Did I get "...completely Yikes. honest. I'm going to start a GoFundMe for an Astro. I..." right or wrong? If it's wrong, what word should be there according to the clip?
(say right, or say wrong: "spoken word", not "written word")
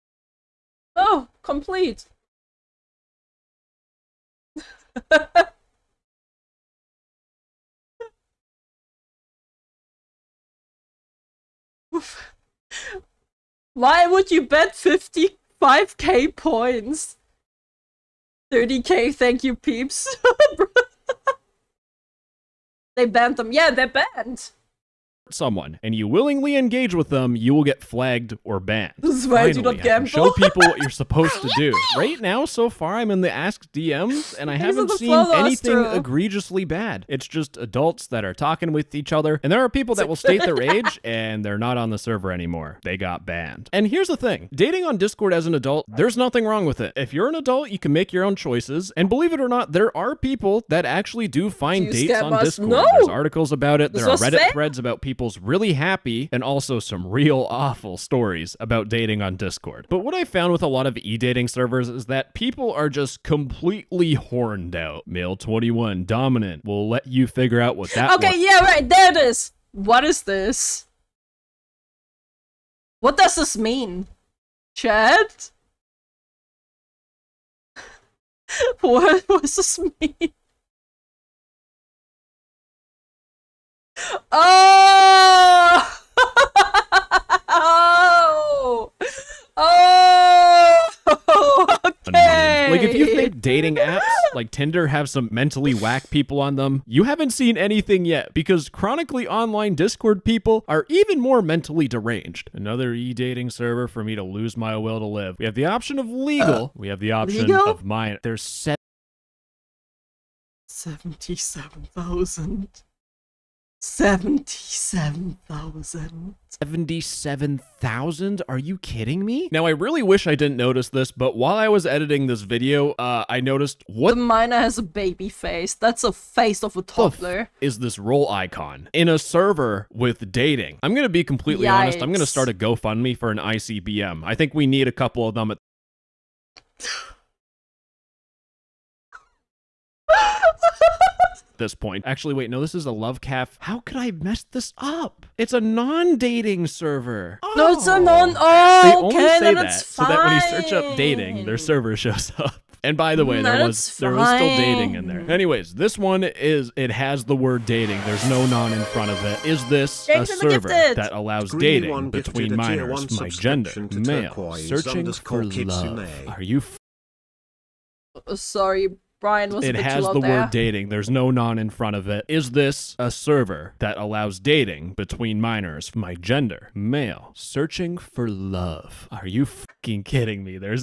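wrong: "ICBM", not "Astro".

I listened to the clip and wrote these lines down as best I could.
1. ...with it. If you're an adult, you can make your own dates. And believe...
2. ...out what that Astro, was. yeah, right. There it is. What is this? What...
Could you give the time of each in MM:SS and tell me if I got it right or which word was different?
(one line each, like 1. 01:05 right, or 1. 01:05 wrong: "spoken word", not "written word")
1. 00:46 wrong: "choices", not "dates"
2. 01:07 wrong: "Okay", not "Astro".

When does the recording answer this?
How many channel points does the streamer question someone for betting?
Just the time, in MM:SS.
00:14.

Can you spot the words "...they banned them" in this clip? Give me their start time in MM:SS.
00:22.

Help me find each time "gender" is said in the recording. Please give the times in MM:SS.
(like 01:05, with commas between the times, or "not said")
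02:43, 02:56.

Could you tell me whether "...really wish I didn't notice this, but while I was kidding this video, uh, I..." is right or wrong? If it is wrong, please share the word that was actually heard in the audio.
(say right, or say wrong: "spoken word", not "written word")
wrong: "editing", not "kidding".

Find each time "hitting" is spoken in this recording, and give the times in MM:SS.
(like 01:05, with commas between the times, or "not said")
not said.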